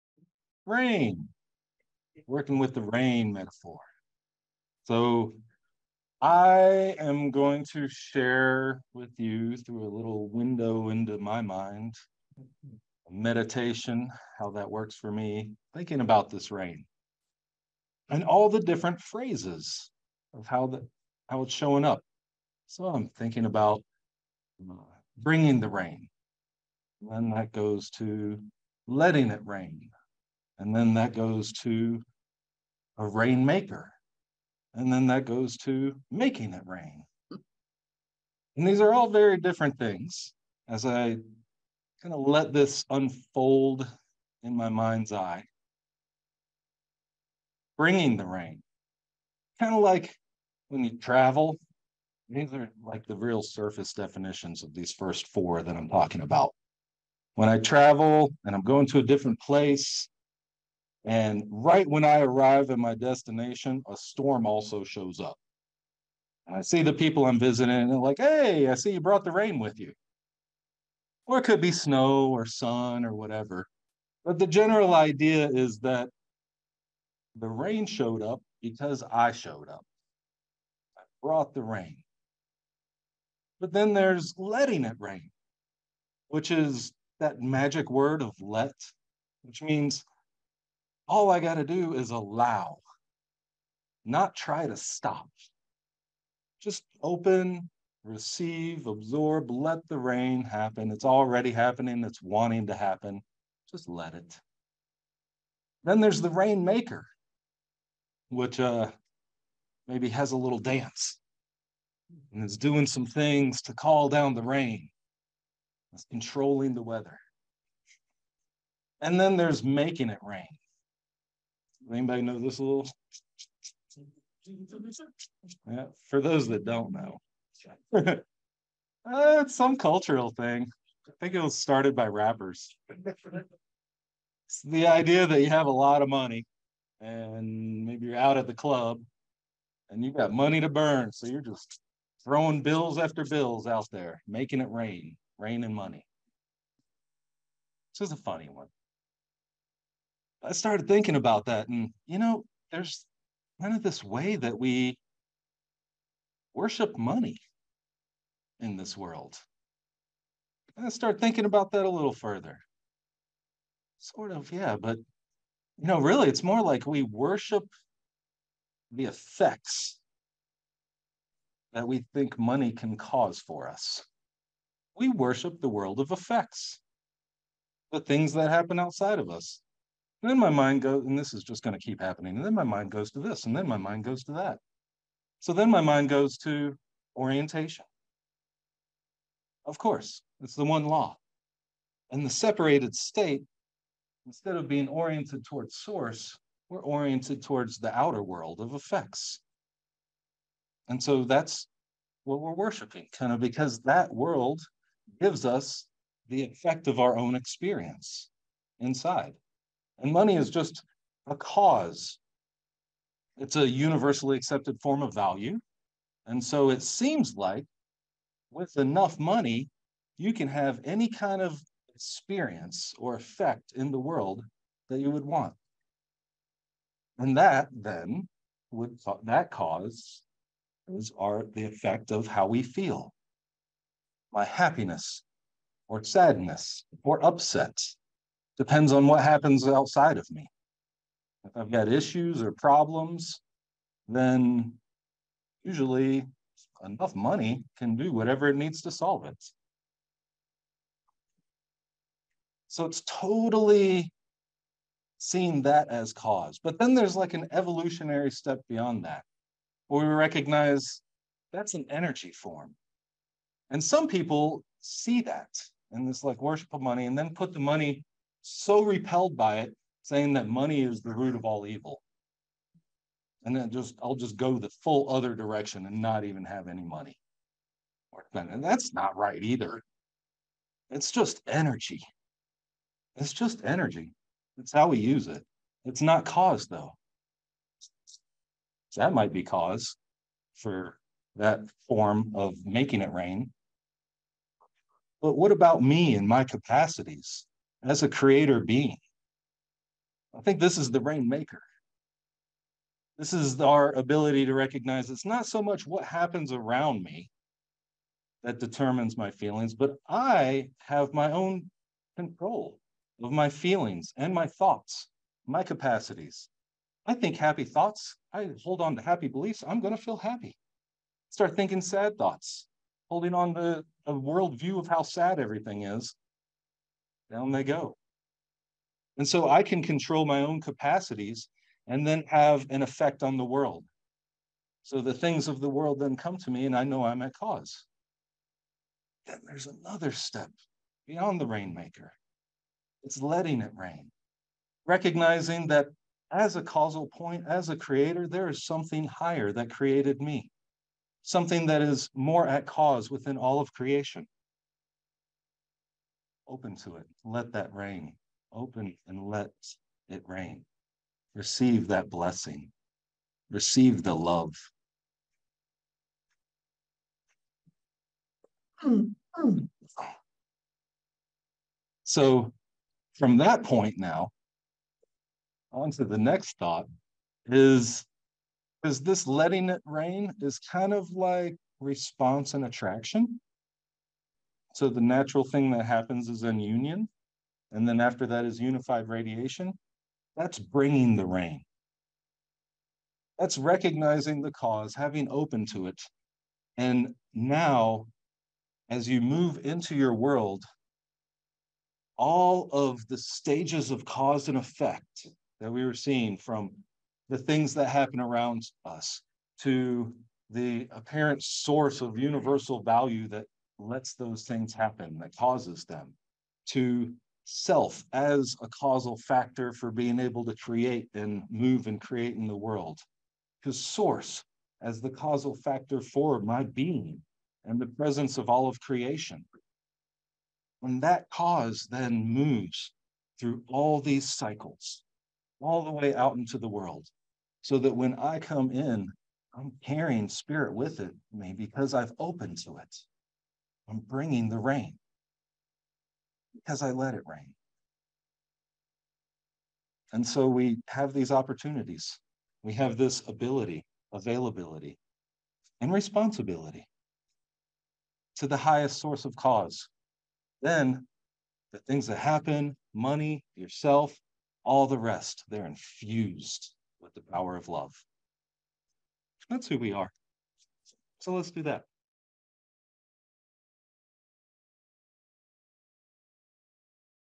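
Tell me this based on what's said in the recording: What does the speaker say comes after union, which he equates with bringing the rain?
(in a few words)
Unified radiation.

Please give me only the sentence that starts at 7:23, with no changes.
I'm bringing the rain because I let it rain.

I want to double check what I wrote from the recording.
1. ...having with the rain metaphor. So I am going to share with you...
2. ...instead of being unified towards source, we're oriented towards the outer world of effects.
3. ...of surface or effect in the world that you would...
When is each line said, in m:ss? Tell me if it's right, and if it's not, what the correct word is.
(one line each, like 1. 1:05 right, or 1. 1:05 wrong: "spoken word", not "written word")
1. 0:02 wrong: "working", not "having"
2. 3:14 wrong: "oriented", not "unified"
3. 3:41 wrong: "experience", not "surface".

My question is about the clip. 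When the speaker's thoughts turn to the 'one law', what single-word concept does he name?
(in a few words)
Orientation.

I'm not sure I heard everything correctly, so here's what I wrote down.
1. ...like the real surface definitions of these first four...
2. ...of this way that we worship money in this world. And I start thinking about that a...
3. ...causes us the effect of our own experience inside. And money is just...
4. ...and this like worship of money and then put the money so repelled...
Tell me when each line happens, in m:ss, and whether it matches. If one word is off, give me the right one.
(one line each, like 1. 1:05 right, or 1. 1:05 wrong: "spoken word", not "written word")
1. 0:52 right
2. 2:33 right
3. 3:25 wrong: "gives", not "causes"
4. 4:25 right.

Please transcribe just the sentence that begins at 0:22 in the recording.
So I'm thinking about uh, bringing the rain.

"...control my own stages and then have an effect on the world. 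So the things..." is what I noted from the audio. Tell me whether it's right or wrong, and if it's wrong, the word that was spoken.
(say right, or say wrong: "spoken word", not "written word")
wrong: "capacities", not "stages".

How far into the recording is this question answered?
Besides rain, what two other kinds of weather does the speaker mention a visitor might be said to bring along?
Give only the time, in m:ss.
1:11.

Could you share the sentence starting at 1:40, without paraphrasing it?
It's already happening, it's wanting to happen.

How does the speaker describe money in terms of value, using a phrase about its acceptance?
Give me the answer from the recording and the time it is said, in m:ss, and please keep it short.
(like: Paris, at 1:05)
Universally accepted form of value, at 3:33.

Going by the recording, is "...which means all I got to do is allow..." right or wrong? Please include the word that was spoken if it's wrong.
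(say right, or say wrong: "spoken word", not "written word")
right.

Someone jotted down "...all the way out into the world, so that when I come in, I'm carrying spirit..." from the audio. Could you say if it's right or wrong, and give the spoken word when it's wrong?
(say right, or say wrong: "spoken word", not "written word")
right.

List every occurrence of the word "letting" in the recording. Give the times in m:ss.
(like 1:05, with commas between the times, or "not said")
0:28, 1:24, 5:43, 6:19.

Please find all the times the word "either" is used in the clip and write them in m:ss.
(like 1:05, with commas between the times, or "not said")
4:39.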